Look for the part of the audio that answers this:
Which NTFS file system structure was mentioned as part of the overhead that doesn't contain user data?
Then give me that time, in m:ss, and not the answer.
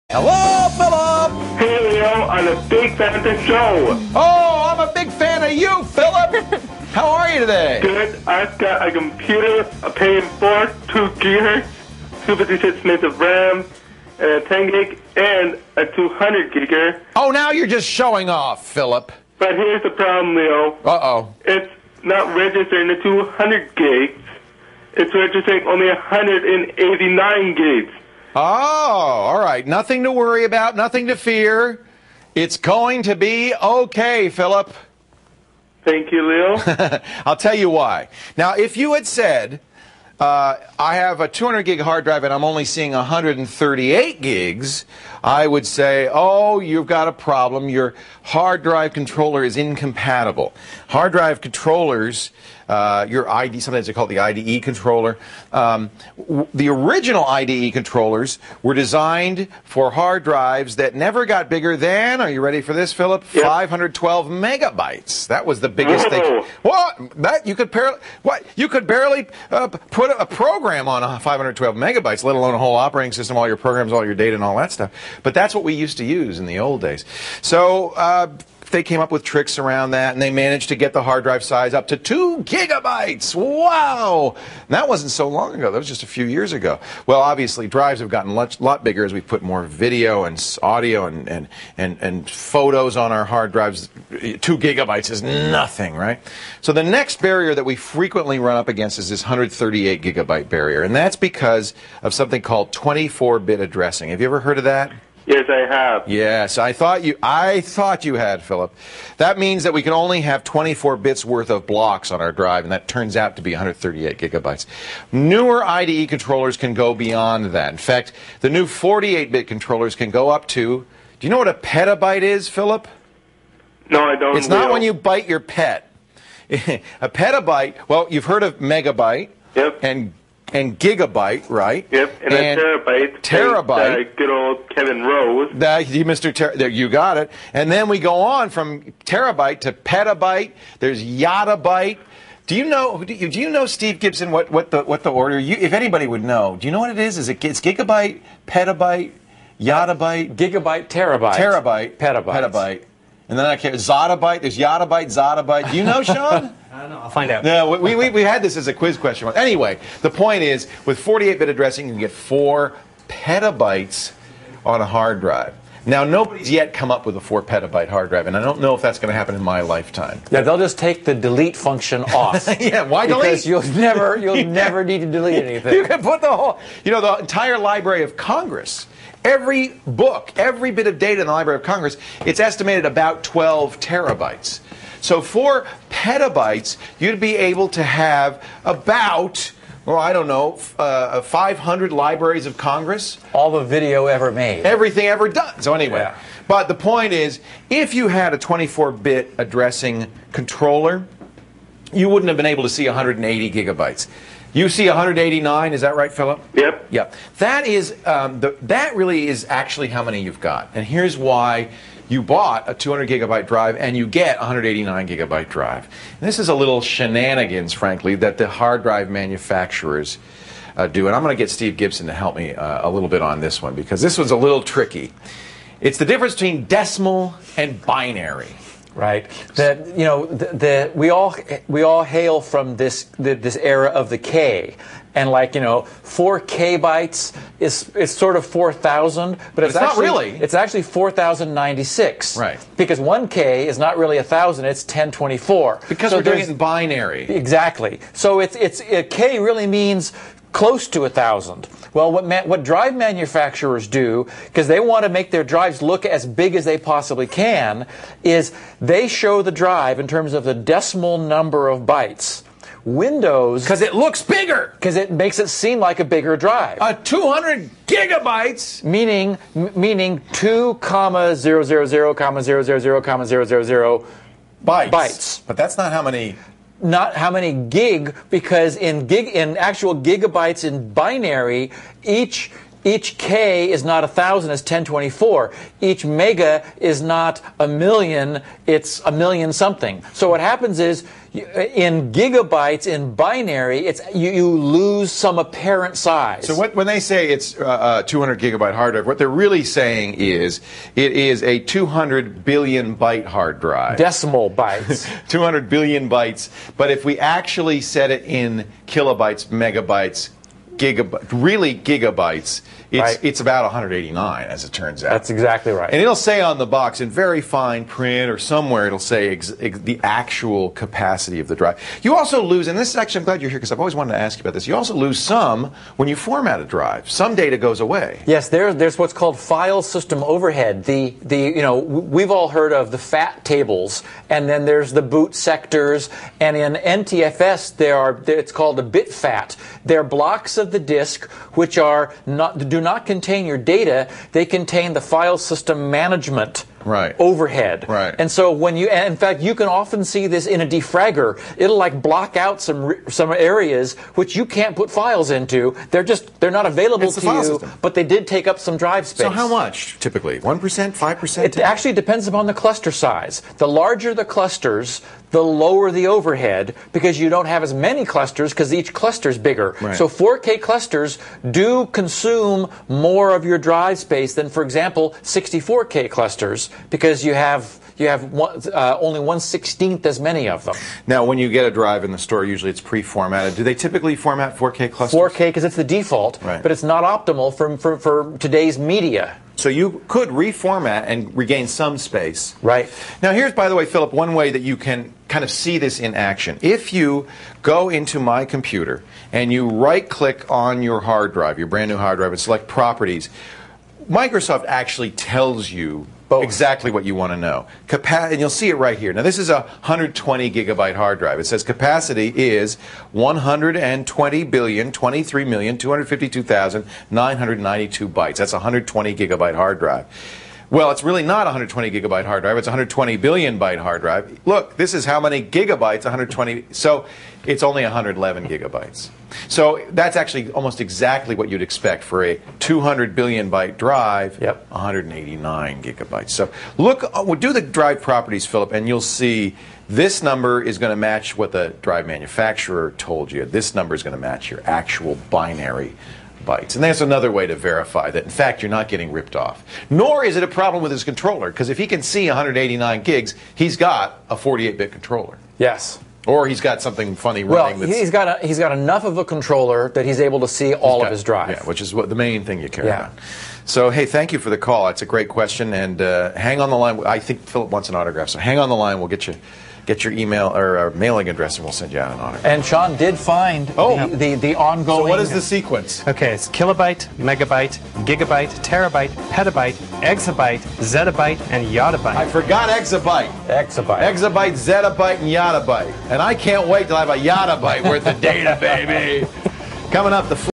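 5:38.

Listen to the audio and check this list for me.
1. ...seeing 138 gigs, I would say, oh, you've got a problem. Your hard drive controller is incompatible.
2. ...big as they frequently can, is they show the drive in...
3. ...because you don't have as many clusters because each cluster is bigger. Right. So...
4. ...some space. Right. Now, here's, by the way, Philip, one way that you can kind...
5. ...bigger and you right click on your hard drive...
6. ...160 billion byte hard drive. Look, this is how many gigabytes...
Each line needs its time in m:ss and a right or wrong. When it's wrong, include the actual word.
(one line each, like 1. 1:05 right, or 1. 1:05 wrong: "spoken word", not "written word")
1. 0:42 right
2. 4:16 wrong: "possibly", not "frequently"
3. 6:06 right
4. 6:31 right
5. 6:38 wrong: "computer", not "bigger"
6. 7:02 wrong: "120", not "160".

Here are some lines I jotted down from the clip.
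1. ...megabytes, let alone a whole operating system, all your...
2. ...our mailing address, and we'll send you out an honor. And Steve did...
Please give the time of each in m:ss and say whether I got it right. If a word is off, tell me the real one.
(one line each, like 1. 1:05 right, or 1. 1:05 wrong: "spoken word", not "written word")
1. 1:11 right
2. 7:50 wrong: "Sean", not "Steve".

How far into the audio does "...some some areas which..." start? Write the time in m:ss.
5:52.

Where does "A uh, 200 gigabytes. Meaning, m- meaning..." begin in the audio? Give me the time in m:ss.
4:26.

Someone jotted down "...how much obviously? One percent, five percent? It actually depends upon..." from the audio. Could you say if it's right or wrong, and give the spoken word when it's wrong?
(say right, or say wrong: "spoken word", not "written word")
wrong: "typically", not "obviously".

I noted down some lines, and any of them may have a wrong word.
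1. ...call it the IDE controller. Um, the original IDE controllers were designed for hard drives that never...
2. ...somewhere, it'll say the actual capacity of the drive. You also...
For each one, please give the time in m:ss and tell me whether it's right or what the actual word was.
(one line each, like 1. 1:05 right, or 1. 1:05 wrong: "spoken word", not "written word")
1. 0:53 right
2. 5:18 right.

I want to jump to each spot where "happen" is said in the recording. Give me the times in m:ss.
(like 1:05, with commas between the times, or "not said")
2:49, 4:50.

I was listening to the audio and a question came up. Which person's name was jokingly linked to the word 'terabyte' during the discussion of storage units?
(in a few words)
Kevin Rose.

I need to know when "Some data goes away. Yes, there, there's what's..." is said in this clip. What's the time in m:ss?
5:27.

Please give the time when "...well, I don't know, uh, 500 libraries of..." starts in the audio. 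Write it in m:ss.
3:09.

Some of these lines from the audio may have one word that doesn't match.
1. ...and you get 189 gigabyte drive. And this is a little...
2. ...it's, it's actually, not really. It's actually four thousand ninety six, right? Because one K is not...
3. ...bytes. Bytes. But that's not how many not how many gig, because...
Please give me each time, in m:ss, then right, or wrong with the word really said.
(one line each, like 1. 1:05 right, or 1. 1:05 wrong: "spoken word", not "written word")
1. 3:33 right
2. 3:59 right
3. 4:34 right.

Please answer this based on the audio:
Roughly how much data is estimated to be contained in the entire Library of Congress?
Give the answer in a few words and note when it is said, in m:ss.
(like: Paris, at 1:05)
12 terabytes, at 3:03.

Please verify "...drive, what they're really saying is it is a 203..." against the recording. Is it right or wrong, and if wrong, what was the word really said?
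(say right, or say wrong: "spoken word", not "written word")
wrong: "200", not "203".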